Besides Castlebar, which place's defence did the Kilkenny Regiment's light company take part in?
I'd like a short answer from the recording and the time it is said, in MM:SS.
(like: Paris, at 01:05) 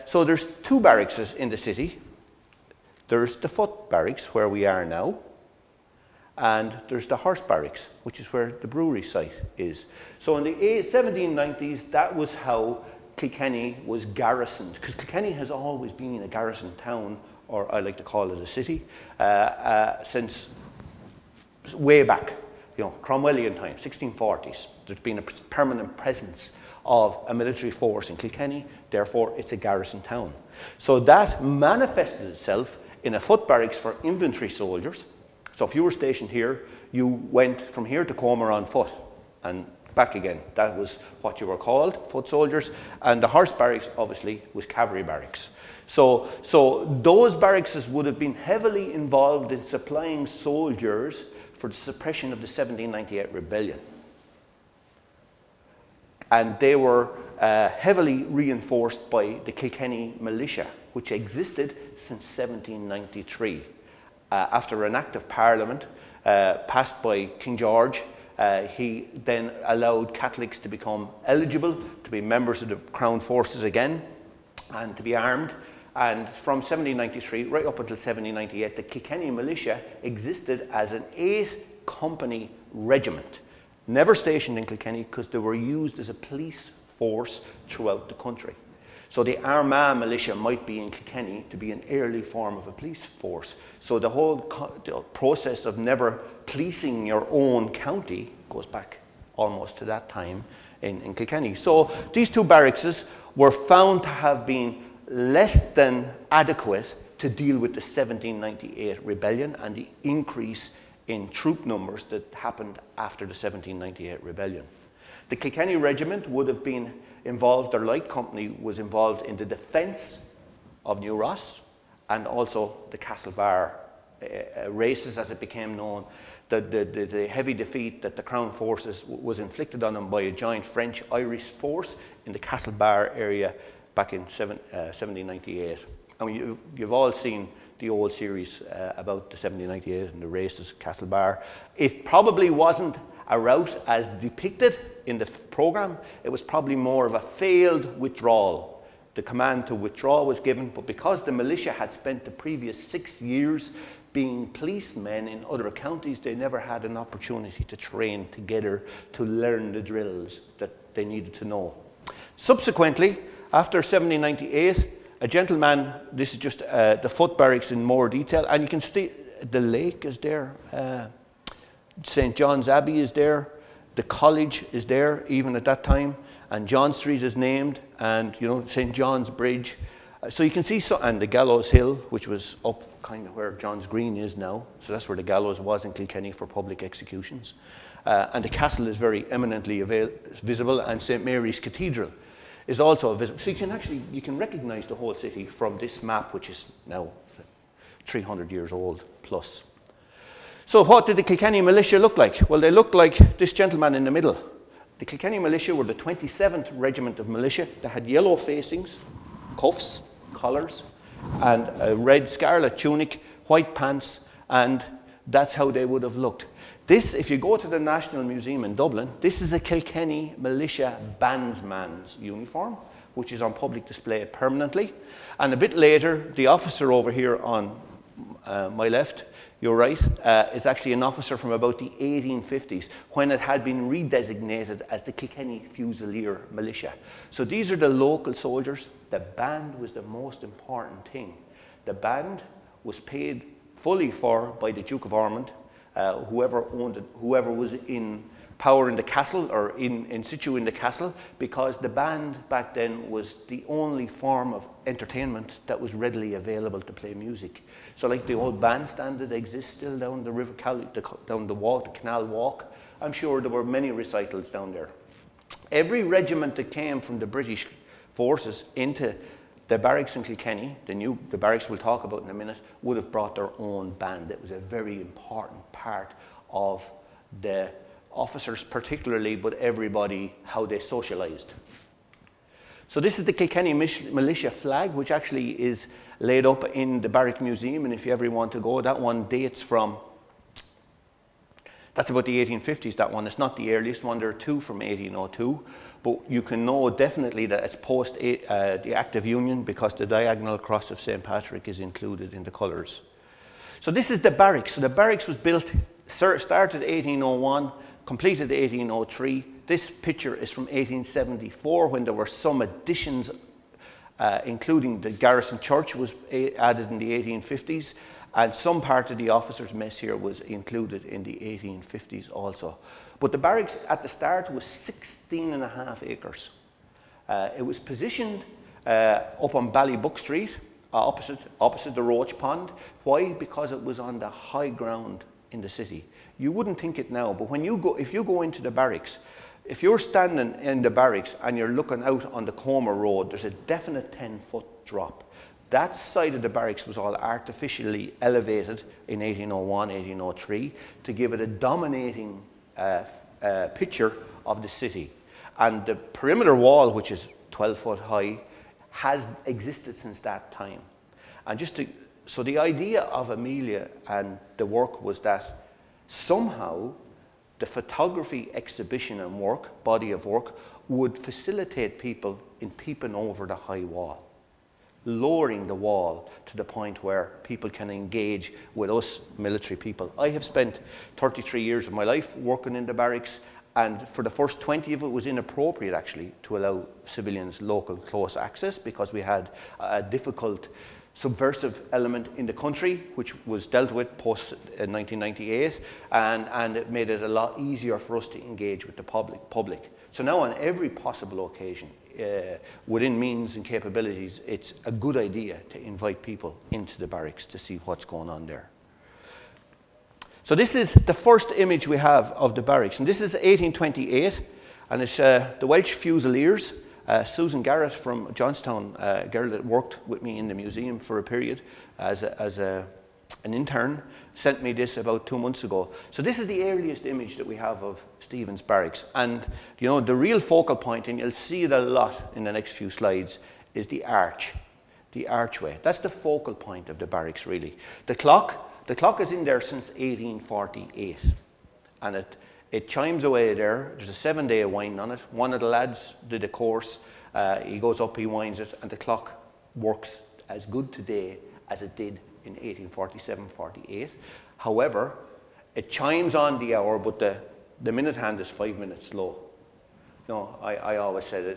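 New Ross, at 01:59.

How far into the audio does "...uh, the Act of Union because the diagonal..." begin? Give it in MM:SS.
04:58.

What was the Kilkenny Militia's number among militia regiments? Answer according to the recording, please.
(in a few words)
27th.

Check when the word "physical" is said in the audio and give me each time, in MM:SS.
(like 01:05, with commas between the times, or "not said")
not said.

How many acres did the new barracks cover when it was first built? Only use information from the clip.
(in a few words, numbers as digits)
16 and a half acres.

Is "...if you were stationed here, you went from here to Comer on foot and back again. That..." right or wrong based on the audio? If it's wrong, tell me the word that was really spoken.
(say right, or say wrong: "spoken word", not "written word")
right.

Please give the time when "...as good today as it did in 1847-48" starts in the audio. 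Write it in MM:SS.
07:30.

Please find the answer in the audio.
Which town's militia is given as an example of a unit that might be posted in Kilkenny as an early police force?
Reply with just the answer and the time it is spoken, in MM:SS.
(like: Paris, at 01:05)
Armagh, at 01:29.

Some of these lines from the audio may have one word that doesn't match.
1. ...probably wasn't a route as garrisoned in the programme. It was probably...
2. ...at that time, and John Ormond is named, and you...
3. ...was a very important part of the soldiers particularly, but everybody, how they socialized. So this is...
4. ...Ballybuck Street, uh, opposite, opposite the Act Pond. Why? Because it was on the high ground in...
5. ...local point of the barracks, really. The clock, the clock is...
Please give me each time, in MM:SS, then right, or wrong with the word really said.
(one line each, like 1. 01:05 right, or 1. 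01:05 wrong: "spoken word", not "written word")
1. 02:22 wrong: "depicted", not "garrisoned"
2. 02:55 wrong: "Street", not "Ormond"
3. 04:34 wrong: "officers", not "soldiers"
4. 05:29 wrong: "Roach", not "Act"
5. 07:16 wrong: "focal", not "local".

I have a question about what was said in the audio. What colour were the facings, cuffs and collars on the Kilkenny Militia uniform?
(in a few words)
Yellow.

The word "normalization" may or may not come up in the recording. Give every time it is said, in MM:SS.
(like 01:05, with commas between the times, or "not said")
not said.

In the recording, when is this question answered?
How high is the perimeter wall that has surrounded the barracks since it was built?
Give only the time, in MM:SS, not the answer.
05:57.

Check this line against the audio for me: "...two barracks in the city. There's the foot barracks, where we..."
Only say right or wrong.
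right.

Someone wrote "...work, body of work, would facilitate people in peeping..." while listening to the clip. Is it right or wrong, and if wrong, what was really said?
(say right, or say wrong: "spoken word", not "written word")
right.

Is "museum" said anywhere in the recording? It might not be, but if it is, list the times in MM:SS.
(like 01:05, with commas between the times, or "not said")
03:38, 04:47, 07:00.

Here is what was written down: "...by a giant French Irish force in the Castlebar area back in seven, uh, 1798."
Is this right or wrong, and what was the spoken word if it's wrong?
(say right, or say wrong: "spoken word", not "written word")
right.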